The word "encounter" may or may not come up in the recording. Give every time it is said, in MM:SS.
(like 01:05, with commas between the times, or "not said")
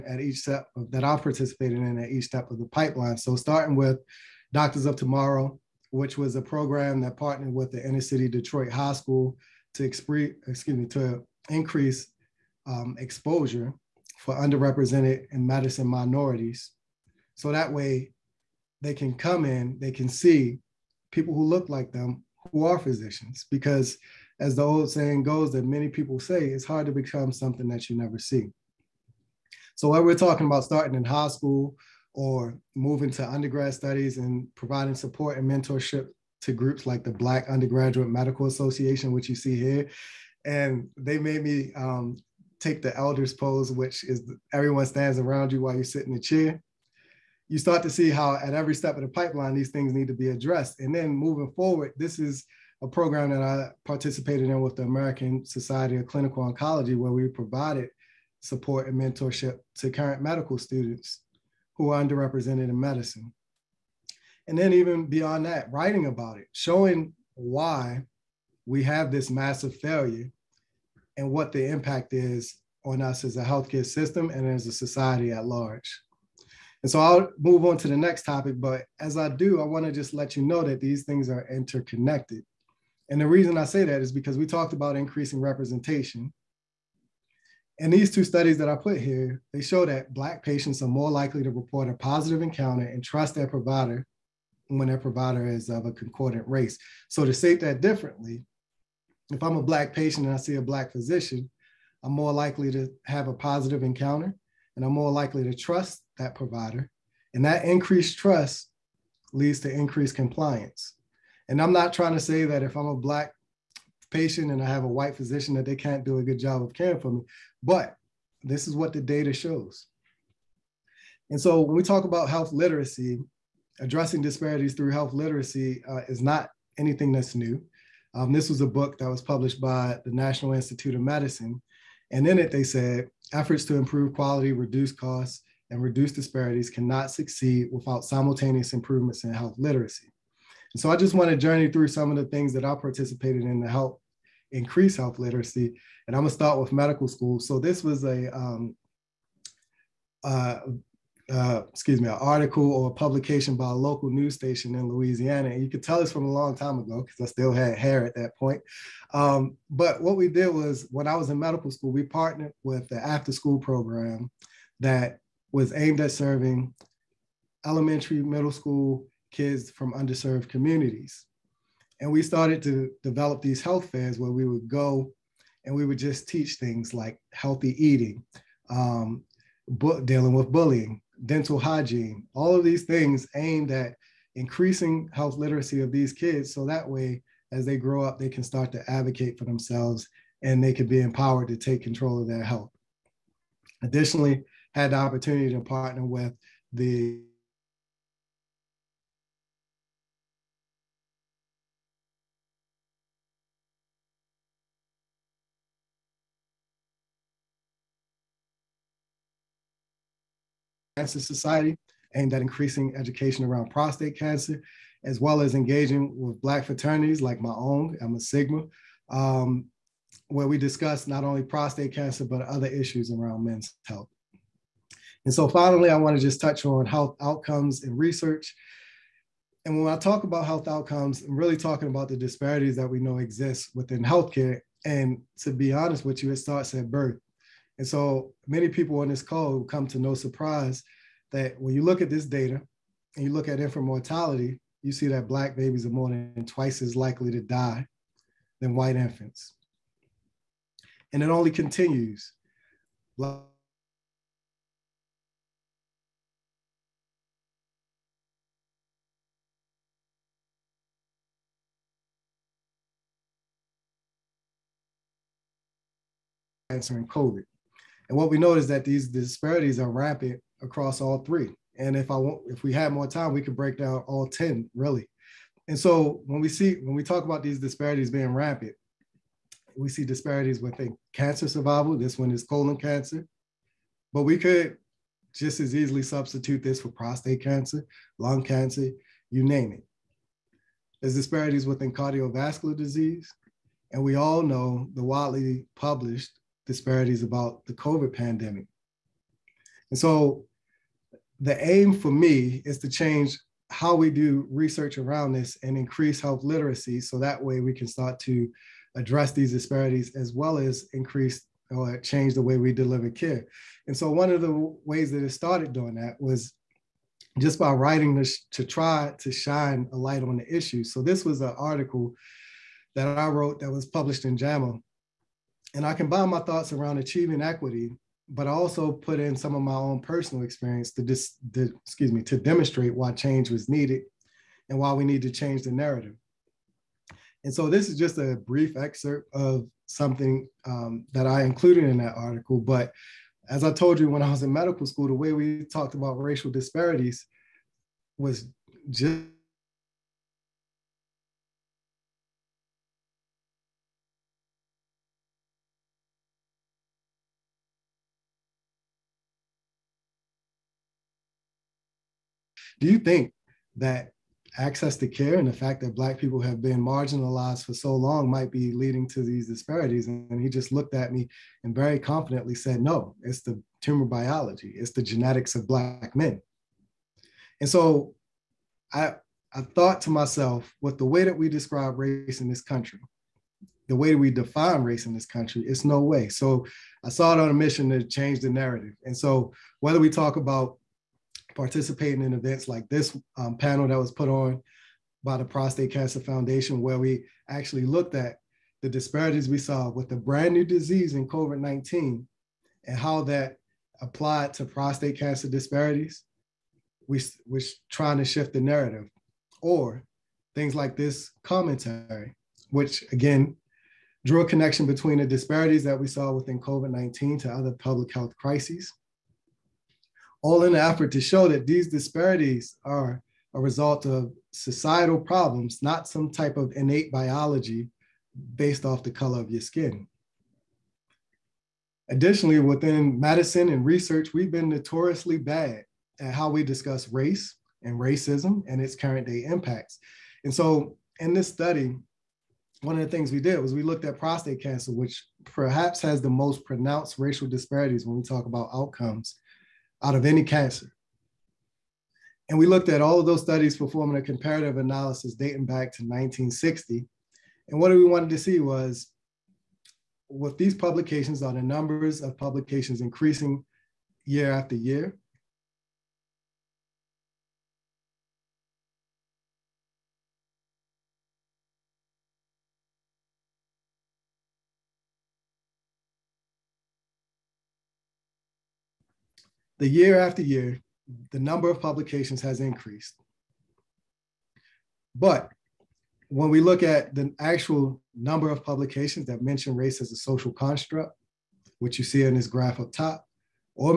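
01:32, 01:43.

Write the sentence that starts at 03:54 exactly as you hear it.
And to be honest with you, it starts at birth.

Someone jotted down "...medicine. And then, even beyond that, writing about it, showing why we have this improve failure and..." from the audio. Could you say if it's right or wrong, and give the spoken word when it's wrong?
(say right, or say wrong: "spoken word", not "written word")
wrong: "massive", not "improve".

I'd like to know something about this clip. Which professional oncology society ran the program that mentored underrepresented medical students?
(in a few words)
American Society of Clinical Oncology.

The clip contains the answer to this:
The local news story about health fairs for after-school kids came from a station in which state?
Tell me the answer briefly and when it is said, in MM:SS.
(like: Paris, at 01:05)
Louisiana, at 02:34.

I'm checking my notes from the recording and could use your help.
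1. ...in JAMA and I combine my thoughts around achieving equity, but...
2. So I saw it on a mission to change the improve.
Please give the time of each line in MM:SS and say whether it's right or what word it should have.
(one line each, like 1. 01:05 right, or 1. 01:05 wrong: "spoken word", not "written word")
1. 05:24 right
2. 06:26 wrong: "narrative", not "improve".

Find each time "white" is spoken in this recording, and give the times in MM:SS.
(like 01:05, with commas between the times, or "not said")
01:54, 04:08.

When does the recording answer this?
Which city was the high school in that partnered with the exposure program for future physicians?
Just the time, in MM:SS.
00:08.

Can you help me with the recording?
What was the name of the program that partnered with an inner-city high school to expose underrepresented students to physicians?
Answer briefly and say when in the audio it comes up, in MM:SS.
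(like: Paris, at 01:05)
Doctors of Tomorrow, at 00:04.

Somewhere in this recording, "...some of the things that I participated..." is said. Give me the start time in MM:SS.
02:21.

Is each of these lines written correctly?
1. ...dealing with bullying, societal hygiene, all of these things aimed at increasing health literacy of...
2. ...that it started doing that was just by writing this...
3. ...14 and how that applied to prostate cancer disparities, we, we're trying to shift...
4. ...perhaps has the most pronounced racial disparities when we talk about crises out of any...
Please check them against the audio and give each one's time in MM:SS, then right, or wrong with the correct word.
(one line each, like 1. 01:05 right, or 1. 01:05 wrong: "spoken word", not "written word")
1. 03:00 wrong: "dental", not "societal"
2. 05:15 right
3. 06:41 wrong: "19", not "14"
4. 07:25 wrong: "outcomes", not "crises".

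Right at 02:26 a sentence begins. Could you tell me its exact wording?
And I'm gonna start with medical school.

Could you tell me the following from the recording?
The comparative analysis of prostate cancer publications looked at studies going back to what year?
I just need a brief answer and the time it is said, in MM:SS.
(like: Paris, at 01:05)
1960, at 07:36.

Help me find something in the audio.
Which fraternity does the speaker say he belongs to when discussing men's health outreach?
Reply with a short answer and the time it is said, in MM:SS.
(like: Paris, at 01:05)
Sigma, at 03:38.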